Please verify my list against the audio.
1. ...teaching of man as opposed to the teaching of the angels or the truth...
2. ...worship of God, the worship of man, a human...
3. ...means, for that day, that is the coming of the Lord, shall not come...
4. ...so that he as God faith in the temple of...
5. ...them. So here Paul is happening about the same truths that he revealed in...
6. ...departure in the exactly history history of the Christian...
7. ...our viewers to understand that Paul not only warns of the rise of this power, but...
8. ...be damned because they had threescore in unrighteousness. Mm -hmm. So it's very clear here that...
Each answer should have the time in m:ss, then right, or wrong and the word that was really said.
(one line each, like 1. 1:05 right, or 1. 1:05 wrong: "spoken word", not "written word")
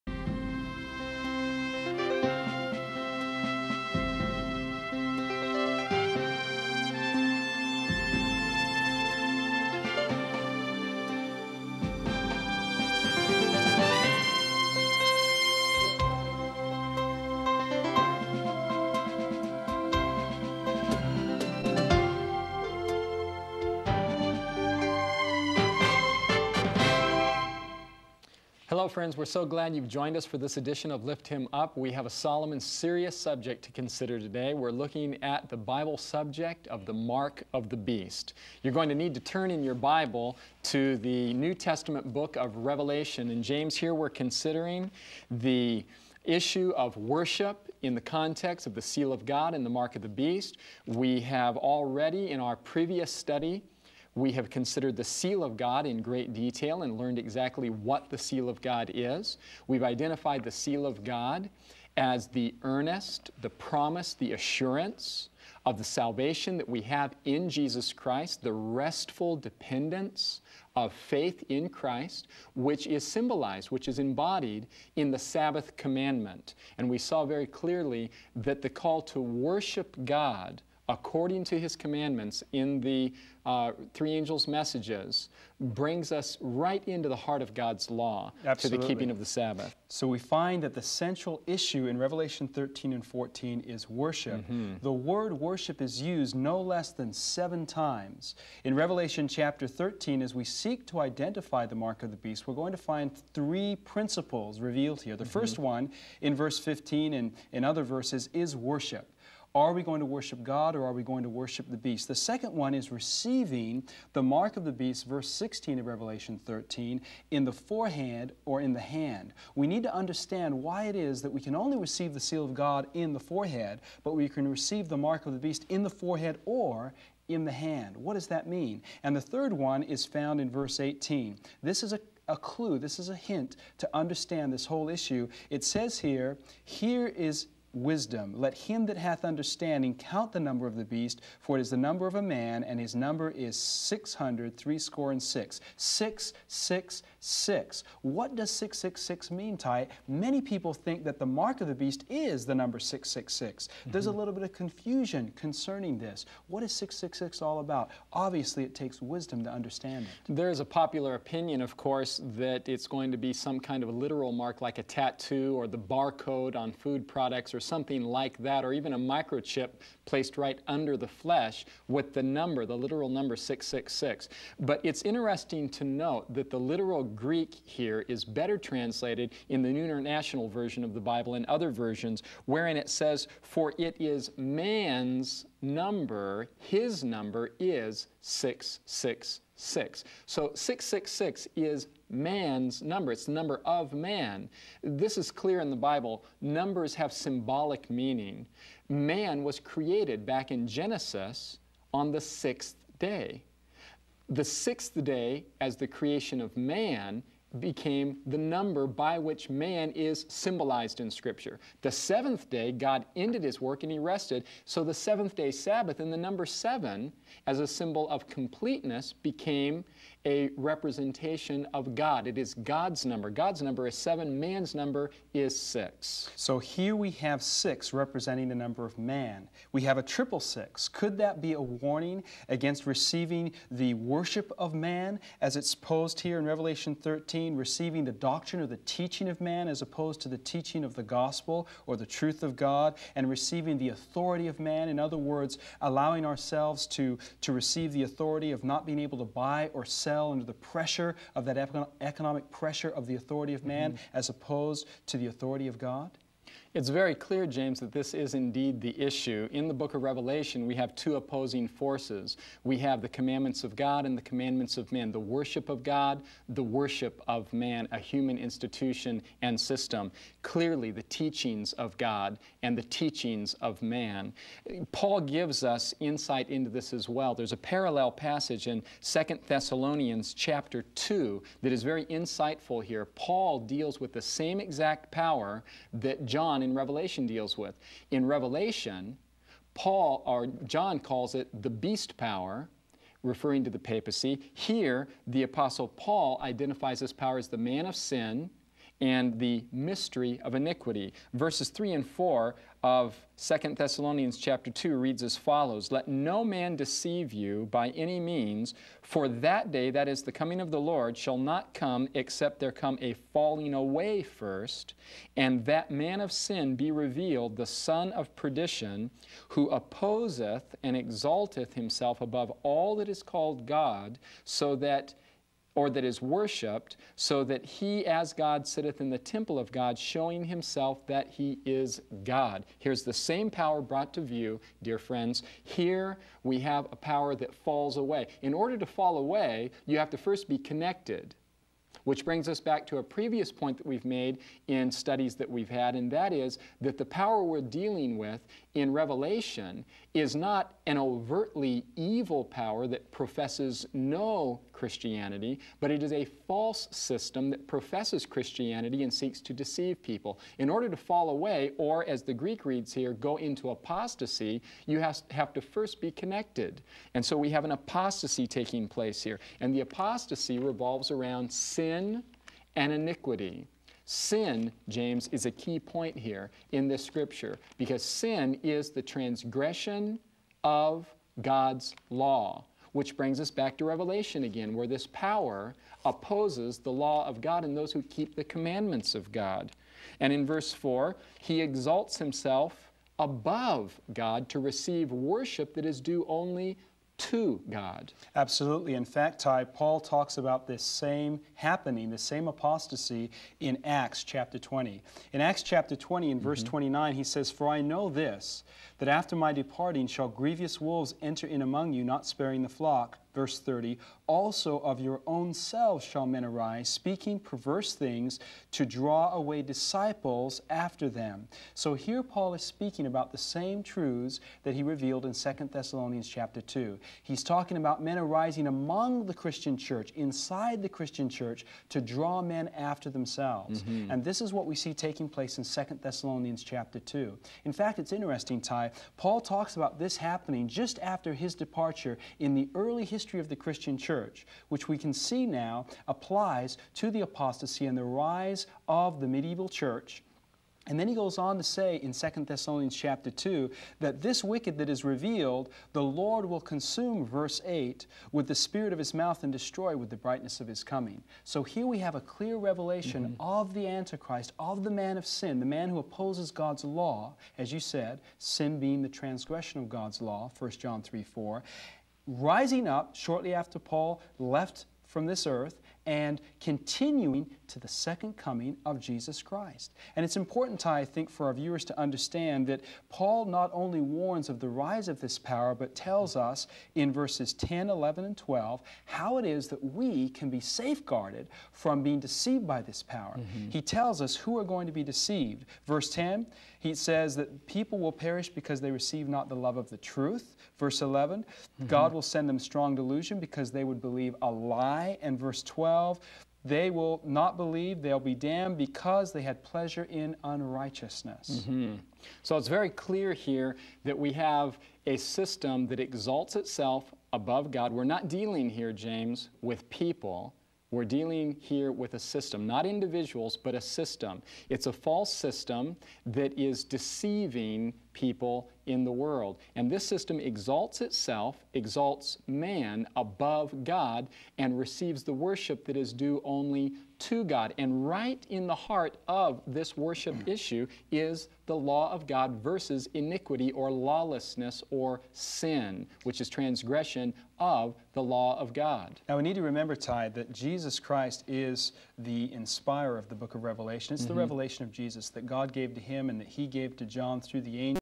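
1. 3:58 wrong: "gospel", not "angels"
2. 4:25 right
3. 5:08 right
4. 5:27 wrong: "sitteth", not "faith"
5. 7:01 wrong: "speaking", not "happening"
6. 7:21 wrong: "early", not "exactly"
7. 8:01 right
8. 8:28 wrong: "pleasure", not "threescore".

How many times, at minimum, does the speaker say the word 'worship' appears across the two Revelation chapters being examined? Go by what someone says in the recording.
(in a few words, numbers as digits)
7.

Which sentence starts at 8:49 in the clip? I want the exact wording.
And this system exalts itself, exalts man above God, and receives the worship that is due only to God.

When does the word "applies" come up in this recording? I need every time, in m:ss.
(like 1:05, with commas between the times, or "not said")
7:26.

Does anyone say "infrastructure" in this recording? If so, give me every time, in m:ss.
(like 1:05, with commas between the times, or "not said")
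not said.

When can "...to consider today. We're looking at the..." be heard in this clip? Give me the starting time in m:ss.
0:33.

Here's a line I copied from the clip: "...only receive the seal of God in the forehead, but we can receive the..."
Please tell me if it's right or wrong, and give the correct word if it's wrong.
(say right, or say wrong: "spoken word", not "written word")
right.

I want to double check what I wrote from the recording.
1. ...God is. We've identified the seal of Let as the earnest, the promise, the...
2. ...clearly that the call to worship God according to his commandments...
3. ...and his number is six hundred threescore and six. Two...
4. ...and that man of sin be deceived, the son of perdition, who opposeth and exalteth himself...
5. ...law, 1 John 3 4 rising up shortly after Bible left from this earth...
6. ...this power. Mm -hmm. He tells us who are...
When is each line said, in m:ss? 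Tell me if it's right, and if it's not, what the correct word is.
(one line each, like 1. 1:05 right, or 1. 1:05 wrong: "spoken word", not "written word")
1. 0:58 wrong: "God", not "Let"
2. 1:17 right
3. 2:22 wrong: "Six", not "Two"
4. 5:15 wrong: "revealed", not "deceived"
5. 7:50 wrong: "Paul", not "Bible"
6. 8:12 right.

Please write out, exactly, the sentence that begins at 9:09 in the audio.
Now we need to remember, Ty, that Jesus Christ is the inspirer of the book of Revelation.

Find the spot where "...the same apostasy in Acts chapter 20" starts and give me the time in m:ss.
6:42.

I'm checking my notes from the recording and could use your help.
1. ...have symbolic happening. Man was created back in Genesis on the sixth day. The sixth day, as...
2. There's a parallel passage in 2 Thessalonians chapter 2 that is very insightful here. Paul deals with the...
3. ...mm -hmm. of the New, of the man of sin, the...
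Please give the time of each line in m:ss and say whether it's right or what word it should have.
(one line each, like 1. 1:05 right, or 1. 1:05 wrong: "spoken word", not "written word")
1. 3:16 wrong: "meaning", not "happening"
2. 4:37 right
3. 7:43 wrong: "Antichrist", not "New".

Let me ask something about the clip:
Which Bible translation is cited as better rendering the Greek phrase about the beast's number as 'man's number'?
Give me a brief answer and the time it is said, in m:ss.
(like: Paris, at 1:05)
New International Version, at 2:59.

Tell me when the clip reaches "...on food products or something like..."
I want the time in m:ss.
2:46.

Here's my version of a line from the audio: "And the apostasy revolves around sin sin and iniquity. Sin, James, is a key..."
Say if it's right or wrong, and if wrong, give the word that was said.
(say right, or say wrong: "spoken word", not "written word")
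right.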